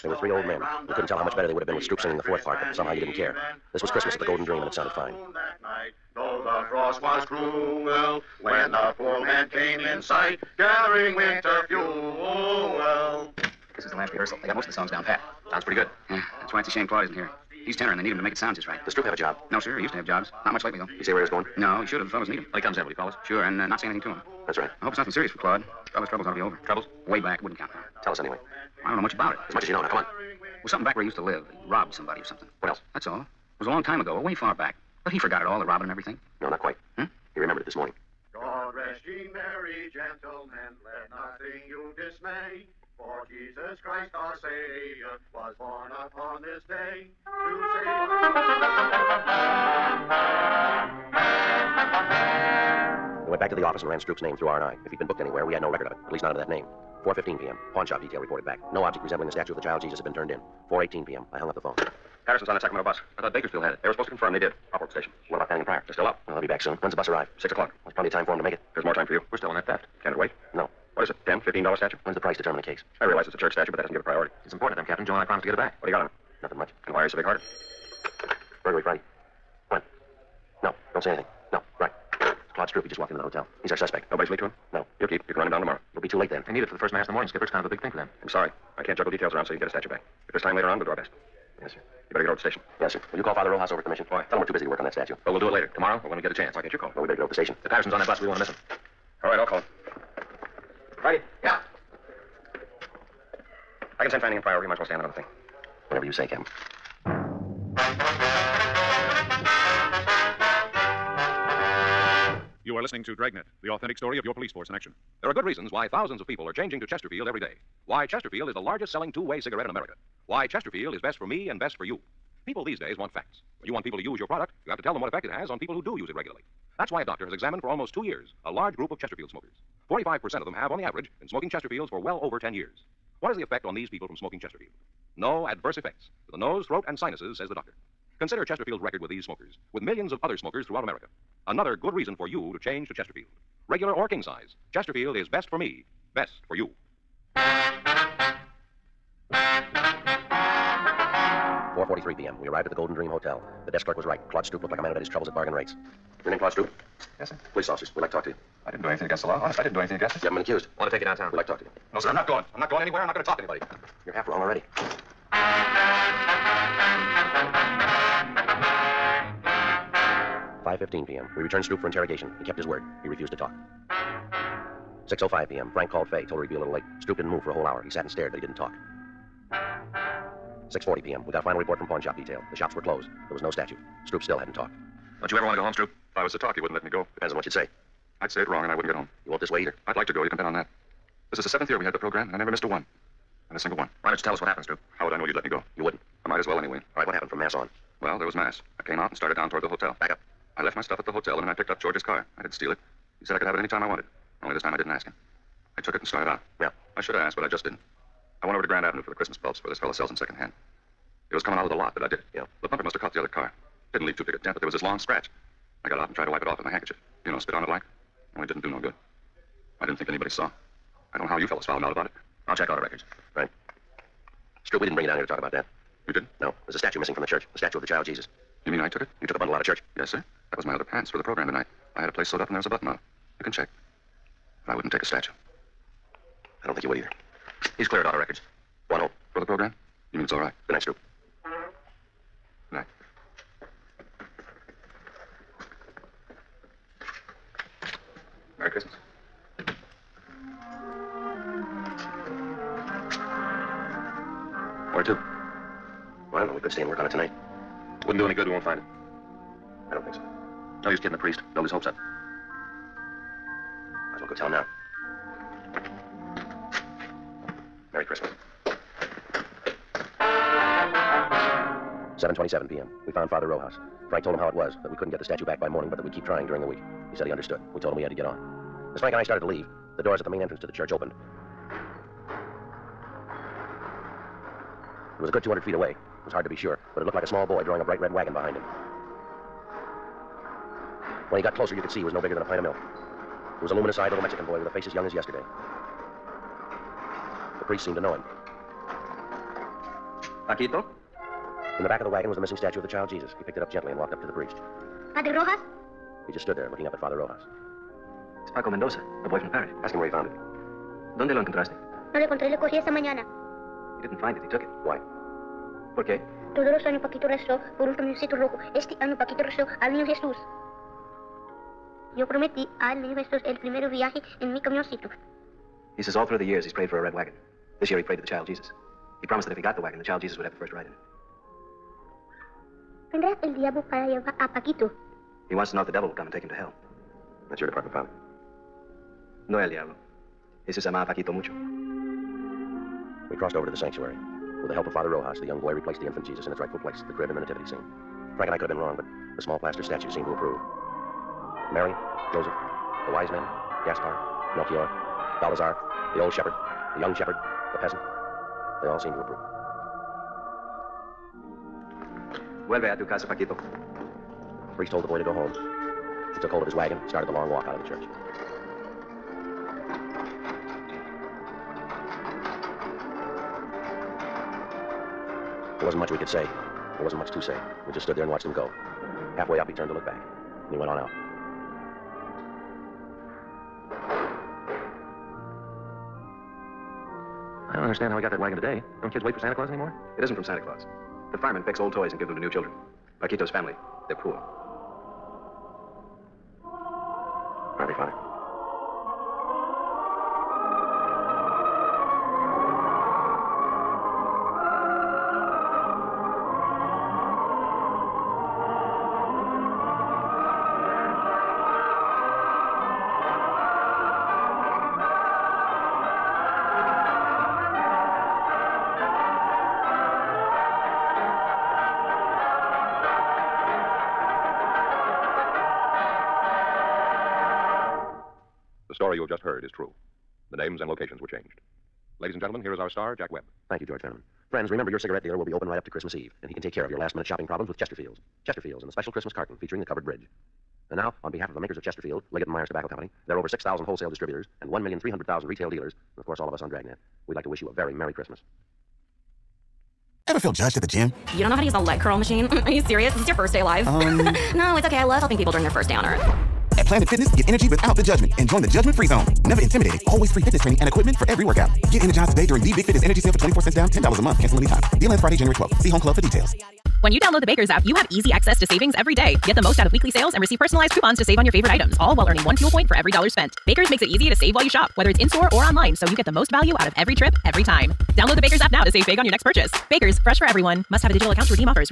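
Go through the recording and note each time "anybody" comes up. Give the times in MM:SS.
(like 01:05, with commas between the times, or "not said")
02:43, 03:40.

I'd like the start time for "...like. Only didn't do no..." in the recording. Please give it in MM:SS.
03:37.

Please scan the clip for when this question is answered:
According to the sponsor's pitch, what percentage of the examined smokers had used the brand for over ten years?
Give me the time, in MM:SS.
02:09.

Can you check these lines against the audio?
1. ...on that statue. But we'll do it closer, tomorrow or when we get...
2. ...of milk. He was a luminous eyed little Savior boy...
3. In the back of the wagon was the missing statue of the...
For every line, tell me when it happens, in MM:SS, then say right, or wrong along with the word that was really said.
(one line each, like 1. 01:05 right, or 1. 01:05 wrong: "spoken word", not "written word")
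1. 01:34 wrong: "later", not "closer"
2. 04:52 wrong: "Mexican", not "Savior"
3. 05:01 right.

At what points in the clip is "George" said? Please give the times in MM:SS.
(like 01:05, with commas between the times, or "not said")
03:21, 07:13.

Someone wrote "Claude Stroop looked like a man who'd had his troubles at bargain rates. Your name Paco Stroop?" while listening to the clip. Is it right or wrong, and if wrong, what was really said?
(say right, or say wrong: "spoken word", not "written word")
wrong: "Claude", not "Paco".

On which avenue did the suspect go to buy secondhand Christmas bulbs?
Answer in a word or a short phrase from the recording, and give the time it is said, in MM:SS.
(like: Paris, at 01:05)
Grand Avenue, at 03:28.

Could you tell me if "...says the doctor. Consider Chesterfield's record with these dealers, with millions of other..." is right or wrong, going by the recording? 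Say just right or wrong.
wrong.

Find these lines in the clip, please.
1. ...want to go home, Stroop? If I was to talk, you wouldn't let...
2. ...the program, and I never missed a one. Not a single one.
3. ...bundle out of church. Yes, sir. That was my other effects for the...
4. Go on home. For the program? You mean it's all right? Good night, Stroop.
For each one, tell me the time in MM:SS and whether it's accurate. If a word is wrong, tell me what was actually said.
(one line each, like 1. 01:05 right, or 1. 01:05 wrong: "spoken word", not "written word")
1. 03:05 right
2. 03:11 right
3. 03:49 wrong: "pants", not "effects"
4. 03:58 right.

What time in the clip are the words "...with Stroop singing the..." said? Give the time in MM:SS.
00:01.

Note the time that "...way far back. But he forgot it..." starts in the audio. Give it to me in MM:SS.
00:34.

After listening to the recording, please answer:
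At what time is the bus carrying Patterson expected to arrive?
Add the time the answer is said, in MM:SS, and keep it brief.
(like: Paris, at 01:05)
6 o'clock, at 01:07.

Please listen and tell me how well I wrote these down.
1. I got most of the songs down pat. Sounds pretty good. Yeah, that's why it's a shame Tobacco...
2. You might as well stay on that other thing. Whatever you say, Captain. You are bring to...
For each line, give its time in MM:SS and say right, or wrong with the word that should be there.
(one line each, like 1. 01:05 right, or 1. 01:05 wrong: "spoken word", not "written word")
1. 00:14 wrong: "Claude", not "Tobacco"
2. 01:44 wrong: "listening", not "bring".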